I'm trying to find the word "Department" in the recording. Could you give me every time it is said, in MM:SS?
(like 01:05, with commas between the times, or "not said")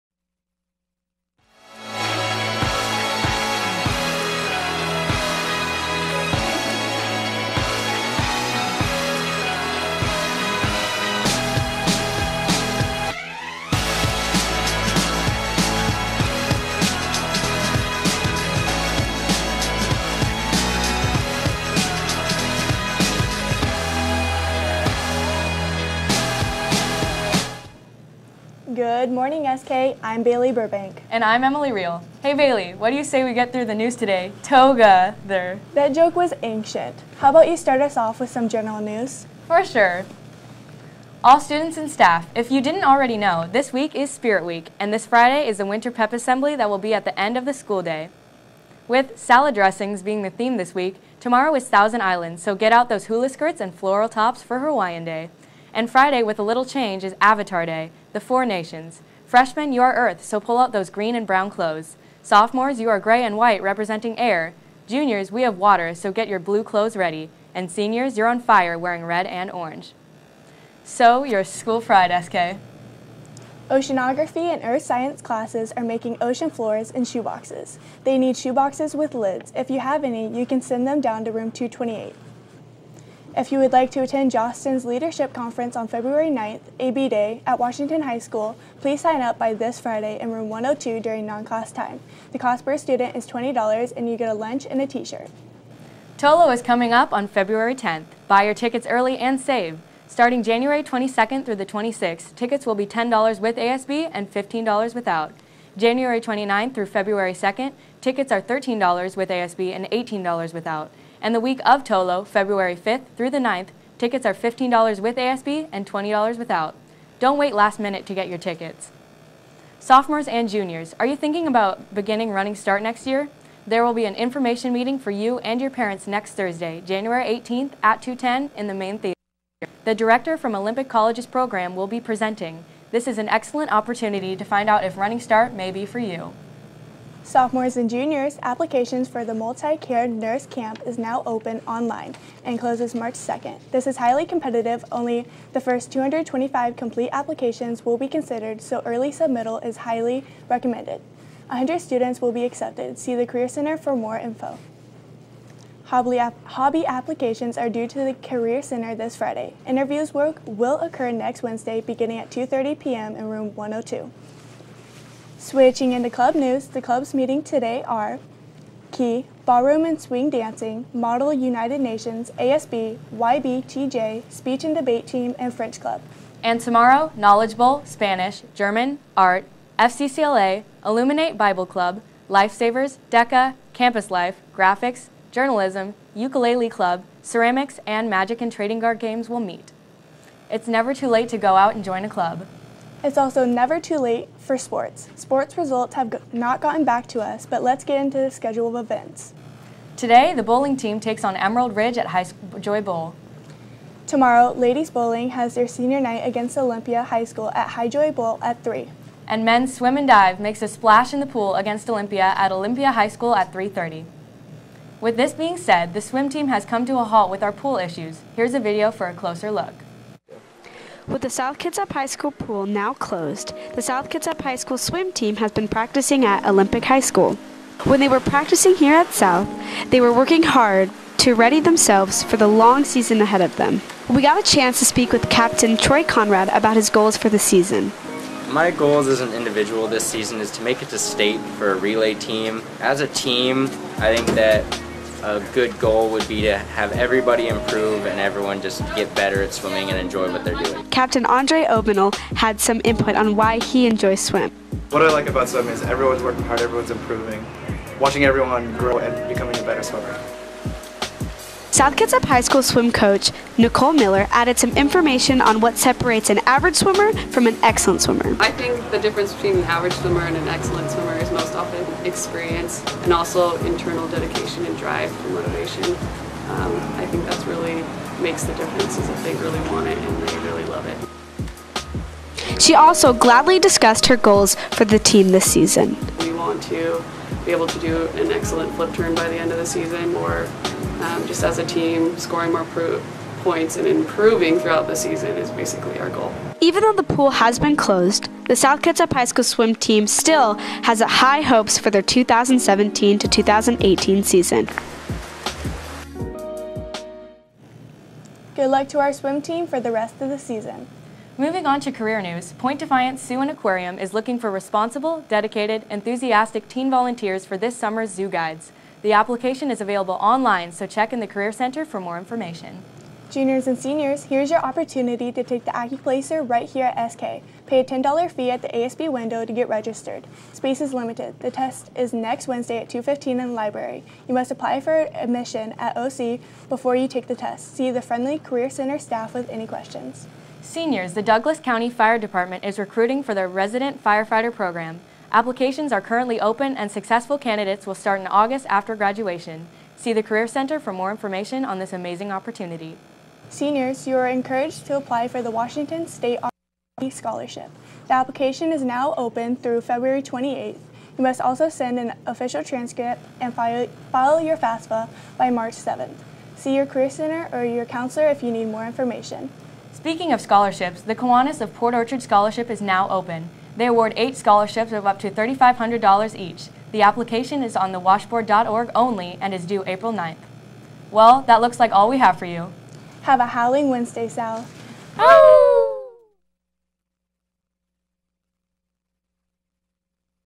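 05:42.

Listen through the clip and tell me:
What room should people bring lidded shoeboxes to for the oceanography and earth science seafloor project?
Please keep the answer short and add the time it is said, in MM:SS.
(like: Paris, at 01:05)
228, at 01:21.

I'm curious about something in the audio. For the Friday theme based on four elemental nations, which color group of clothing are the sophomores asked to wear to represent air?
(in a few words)
gray and white.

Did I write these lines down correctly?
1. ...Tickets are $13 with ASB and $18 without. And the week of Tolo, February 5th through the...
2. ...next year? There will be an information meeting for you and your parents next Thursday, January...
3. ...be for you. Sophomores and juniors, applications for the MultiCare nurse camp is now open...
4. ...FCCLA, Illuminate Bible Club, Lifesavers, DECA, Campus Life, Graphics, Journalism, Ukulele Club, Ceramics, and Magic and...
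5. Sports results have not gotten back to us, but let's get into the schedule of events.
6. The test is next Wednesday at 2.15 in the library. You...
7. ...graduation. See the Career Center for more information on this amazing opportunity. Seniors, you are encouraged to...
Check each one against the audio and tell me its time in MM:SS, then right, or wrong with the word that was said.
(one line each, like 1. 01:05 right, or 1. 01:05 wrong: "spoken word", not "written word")
1. 01:48 right
2. 02:02 right
3. 02:15 right
4. 02:59 right
5. 03:15 right
6. 05:31 right
7. 05:48 right.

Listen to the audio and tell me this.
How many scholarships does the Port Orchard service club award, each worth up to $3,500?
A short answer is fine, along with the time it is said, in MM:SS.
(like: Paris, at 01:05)
8, at 06:14.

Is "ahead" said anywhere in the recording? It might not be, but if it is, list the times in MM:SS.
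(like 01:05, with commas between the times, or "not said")
03:53.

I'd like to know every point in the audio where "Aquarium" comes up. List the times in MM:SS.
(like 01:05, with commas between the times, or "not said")
05:13.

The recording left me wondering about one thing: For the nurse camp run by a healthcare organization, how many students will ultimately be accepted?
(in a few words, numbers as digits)
100.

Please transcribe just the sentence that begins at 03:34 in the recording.
With this being said, the swim team has come to a halt with our pool issues.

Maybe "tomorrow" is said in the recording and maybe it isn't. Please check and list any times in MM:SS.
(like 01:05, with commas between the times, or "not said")
00:51, 02:56, 03:24.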